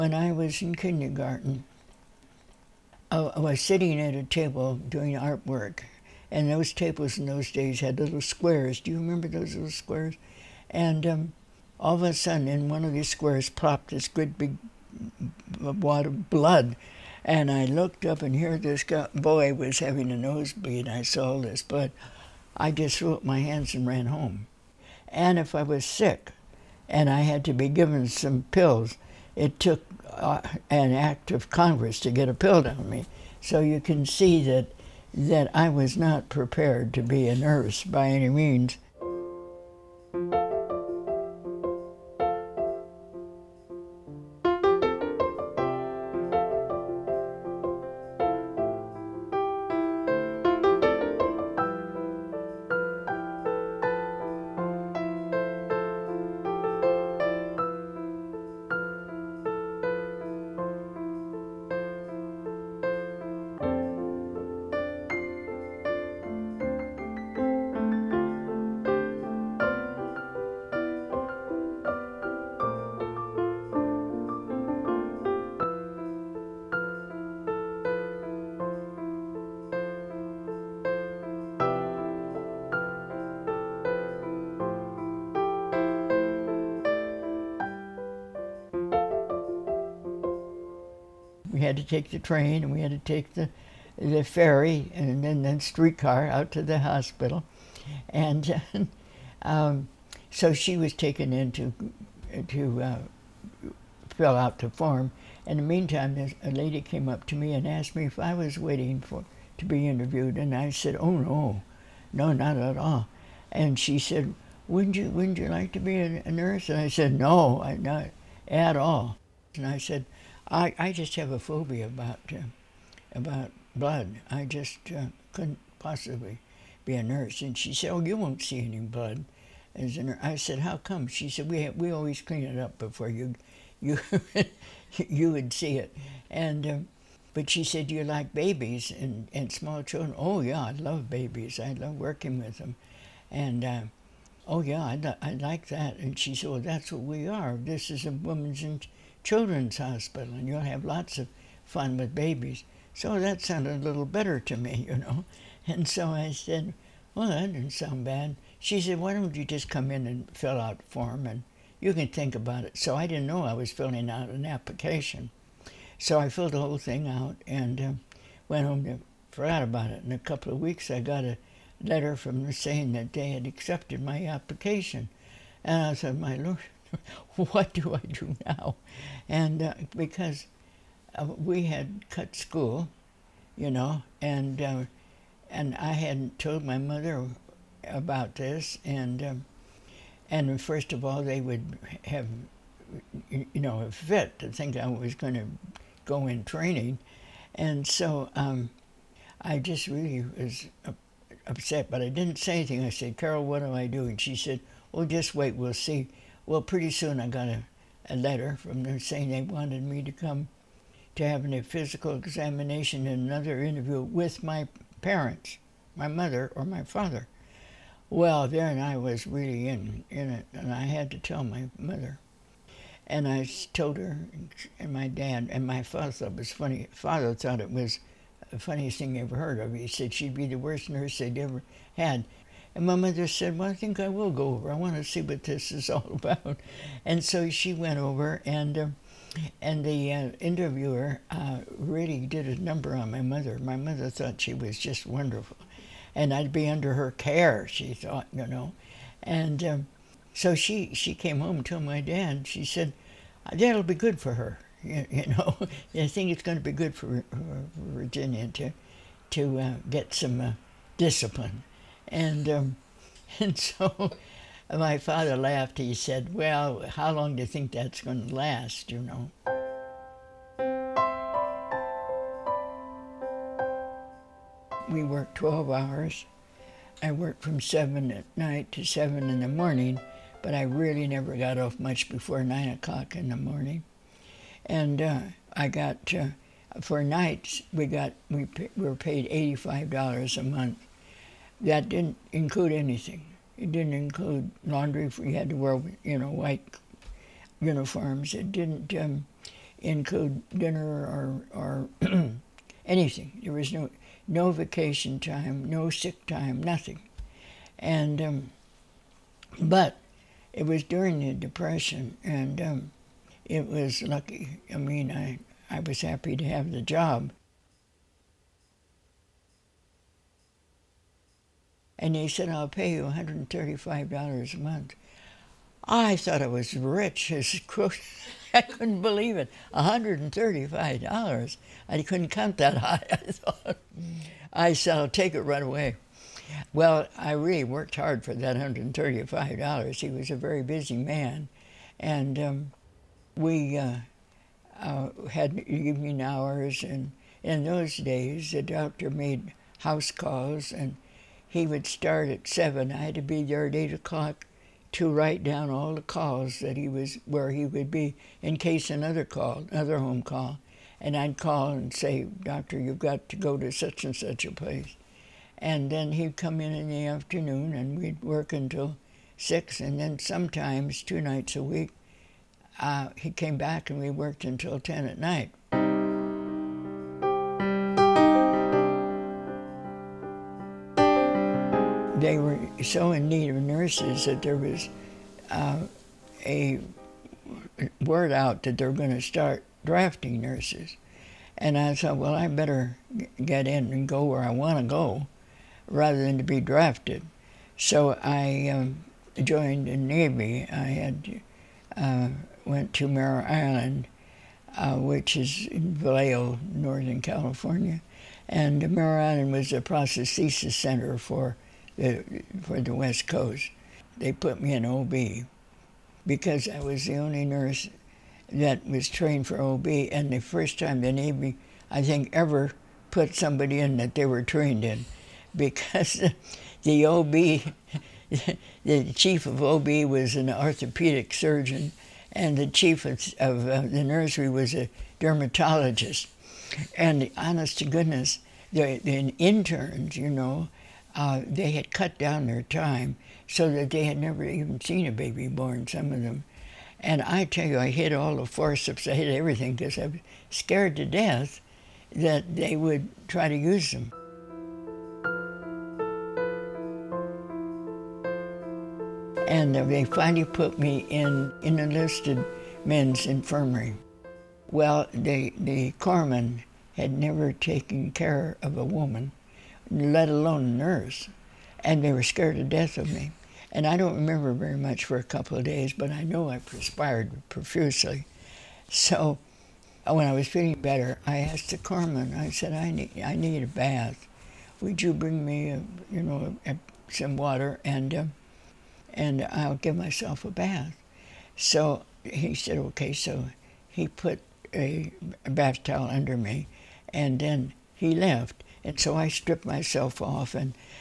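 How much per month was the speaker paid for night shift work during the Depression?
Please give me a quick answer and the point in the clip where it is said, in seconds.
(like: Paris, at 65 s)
$85, at 289 s.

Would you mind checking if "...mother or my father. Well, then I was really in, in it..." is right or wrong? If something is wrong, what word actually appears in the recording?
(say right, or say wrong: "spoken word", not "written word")
right.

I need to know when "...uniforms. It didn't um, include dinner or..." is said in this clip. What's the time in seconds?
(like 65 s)
297 s.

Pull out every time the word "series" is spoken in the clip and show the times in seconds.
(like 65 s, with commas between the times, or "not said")
not said.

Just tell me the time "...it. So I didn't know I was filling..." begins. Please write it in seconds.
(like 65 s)
162 s.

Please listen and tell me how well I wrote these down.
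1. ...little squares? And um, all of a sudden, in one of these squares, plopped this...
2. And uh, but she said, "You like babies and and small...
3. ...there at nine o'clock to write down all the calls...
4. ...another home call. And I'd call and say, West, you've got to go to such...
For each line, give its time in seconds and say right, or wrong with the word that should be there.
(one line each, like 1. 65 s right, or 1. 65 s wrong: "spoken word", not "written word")
1. 9 s right
2. 136 s right
3. 353 s wrong: "eight", not "nine"
4. 359 s wrong: "Doctor", not "West".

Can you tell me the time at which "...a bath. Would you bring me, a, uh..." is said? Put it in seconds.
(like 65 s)
483 s.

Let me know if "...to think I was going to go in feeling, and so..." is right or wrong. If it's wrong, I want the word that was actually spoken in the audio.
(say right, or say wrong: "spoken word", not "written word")
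wrong: "training", not "feeling".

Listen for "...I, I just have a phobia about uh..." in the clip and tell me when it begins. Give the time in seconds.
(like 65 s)
120 s.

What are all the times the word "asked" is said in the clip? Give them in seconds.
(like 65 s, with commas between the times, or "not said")
107 s, 481 s.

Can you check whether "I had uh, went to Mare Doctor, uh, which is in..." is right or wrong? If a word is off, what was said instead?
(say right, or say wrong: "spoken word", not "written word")
wrong: "Island", not "Doctor".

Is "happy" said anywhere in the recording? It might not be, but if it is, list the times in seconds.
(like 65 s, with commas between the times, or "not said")
316 s.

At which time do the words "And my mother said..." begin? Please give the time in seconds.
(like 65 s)
232 s.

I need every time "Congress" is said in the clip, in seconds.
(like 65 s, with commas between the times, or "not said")
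31 s.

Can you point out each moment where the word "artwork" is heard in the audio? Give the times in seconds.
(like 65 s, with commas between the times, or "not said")
5 s.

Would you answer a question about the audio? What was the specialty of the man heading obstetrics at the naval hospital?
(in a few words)
Orthopedic surgeon.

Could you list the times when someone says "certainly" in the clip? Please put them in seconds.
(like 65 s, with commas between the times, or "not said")
not said.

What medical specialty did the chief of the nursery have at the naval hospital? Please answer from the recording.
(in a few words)
Dermatologist.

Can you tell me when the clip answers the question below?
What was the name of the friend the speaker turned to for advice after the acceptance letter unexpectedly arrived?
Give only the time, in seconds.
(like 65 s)
203 s.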